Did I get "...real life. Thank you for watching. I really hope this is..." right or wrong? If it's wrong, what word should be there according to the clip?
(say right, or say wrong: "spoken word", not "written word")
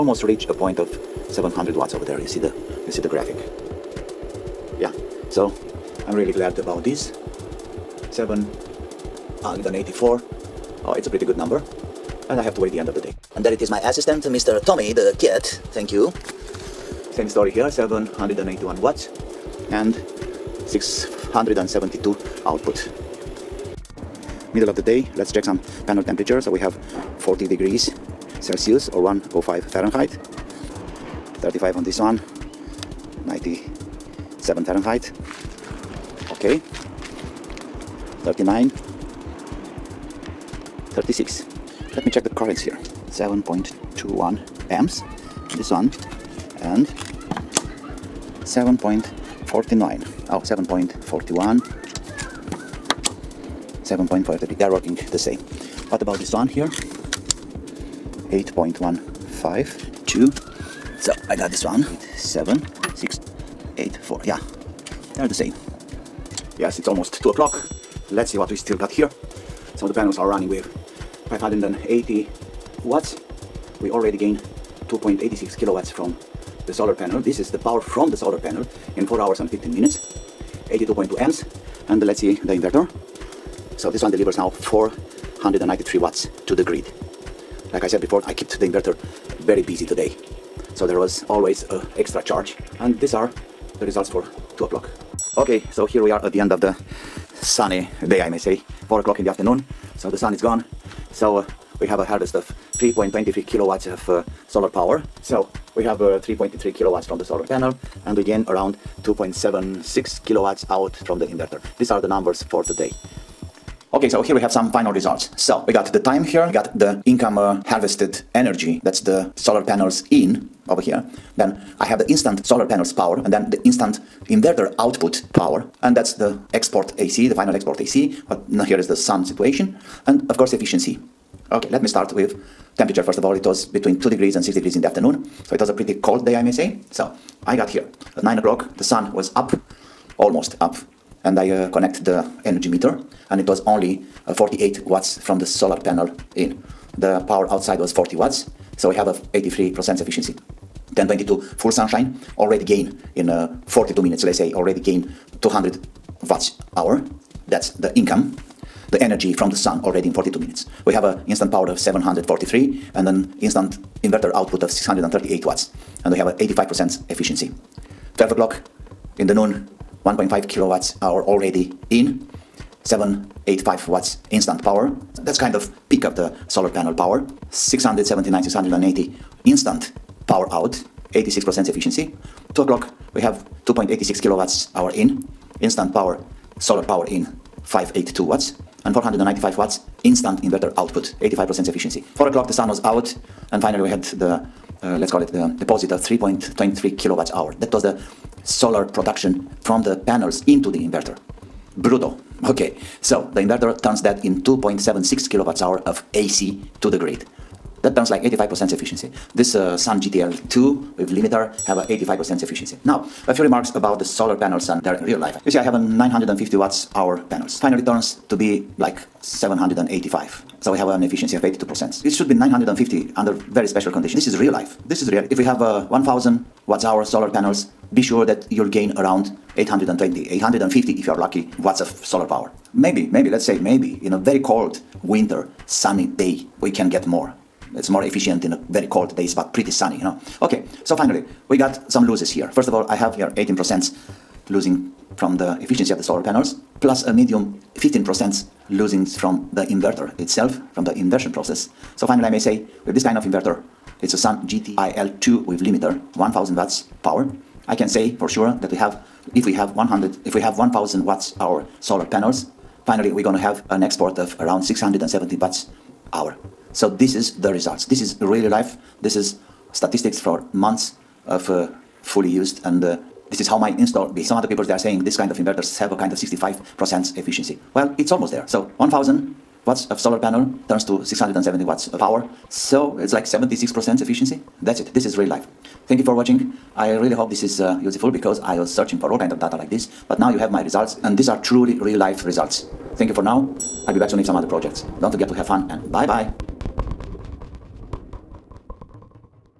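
right.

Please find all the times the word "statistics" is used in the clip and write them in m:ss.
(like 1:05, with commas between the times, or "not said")
4:29.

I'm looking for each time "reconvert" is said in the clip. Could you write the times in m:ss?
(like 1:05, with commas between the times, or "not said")
not said.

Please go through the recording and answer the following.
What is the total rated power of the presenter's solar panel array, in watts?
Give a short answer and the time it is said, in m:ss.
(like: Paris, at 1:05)
950 watts, at 3:35.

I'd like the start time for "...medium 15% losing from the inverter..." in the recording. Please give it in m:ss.
4:07.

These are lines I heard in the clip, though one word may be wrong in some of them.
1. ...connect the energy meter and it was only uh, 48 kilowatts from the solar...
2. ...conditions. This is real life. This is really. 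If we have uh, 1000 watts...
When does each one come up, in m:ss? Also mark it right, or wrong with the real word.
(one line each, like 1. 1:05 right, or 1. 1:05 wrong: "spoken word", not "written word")
1. 2:21 wrong: "watts", not "kilowatts"
2. 3:43 right.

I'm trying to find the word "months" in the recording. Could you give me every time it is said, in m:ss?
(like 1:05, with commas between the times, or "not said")
4:30.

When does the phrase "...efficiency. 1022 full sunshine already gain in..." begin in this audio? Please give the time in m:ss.
2:30.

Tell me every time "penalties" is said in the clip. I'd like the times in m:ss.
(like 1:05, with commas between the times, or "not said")
not said.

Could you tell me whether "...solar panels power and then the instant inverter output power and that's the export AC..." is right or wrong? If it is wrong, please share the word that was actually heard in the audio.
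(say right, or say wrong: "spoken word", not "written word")
right.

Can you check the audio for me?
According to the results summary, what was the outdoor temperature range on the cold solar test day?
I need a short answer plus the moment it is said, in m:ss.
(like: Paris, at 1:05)
2 to 6 degrees, at 2:13.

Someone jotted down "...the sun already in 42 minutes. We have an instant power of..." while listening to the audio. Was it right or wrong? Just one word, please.
right.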